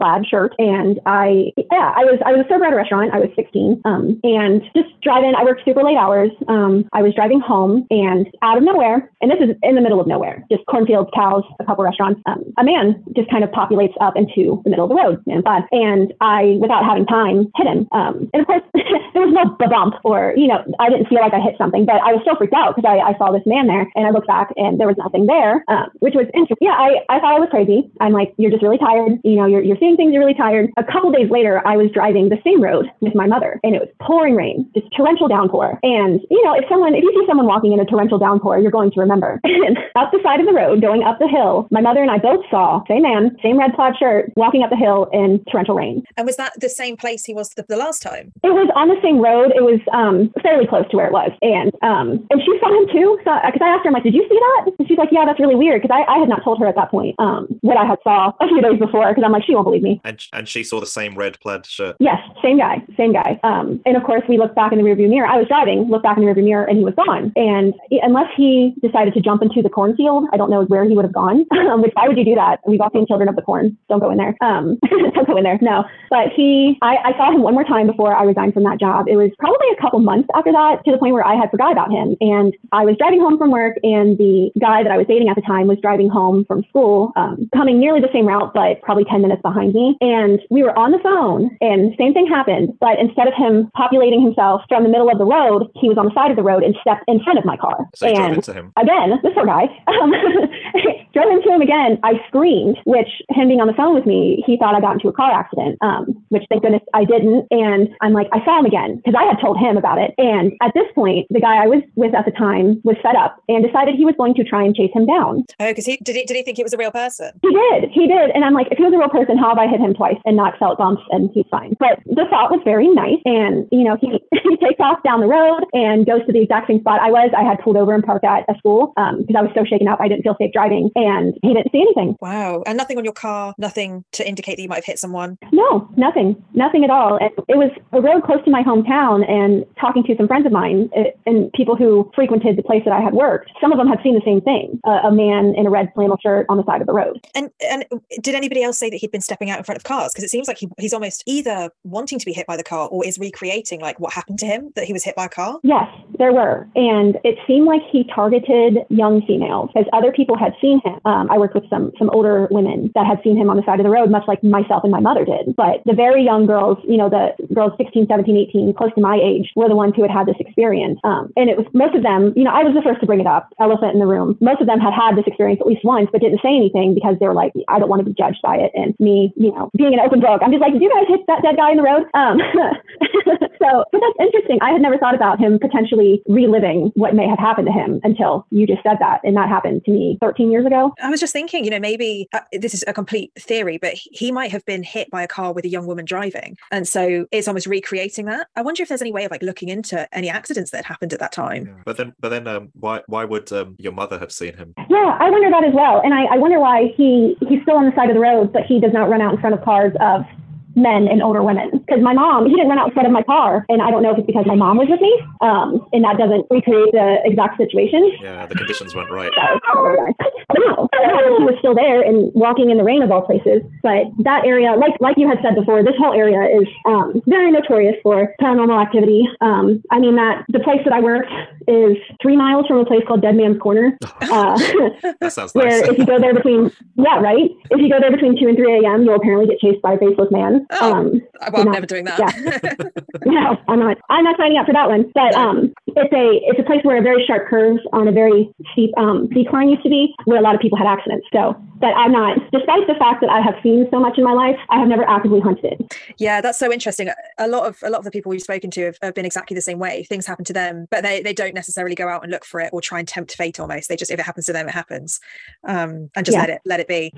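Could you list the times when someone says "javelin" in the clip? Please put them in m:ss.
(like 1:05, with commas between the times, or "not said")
not said.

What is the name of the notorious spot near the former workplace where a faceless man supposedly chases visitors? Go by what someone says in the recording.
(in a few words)
Dead Man's Corner.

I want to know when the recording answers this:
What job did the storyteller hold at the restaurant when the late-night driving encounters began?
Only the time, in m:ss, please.
0:02.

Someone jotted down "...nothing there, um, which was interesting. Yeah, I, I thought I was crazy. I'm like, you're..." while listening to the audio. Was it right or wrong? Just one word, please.
right.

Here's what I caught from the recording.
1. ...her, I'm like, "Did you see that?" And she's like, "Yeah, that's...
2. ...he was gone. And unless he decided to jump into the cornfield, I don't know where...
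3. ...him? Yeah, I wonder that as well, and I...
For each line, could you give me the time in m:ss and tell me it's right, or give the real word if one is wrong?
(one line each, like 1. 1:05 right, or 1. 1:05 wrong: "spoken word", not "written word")
1. 0:53 right
2. 1:06 right
3. 3:24 right.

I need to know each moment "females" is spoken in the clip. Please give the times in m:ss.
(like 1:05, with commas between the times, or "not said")
2:39.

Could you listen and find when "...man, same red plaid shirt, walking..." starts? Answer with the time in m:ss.
0:43.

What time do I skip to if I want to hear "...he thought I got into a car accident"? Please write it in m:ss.
1:44.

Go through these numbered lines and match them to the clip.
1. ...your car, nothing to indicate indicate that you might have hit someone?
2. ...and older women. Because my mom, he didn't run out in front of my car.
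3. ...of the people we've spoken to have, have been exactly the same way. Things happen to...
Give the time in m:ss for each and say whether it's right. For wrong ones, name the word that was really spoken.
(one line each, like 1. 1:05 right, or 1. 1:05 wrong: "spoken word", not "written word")
1. 2:13 right
2. 3:31 right
3. 4:17 right.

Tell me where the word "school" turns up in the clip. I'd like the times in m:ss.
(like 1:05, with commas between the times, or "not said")
1:26, 2:08.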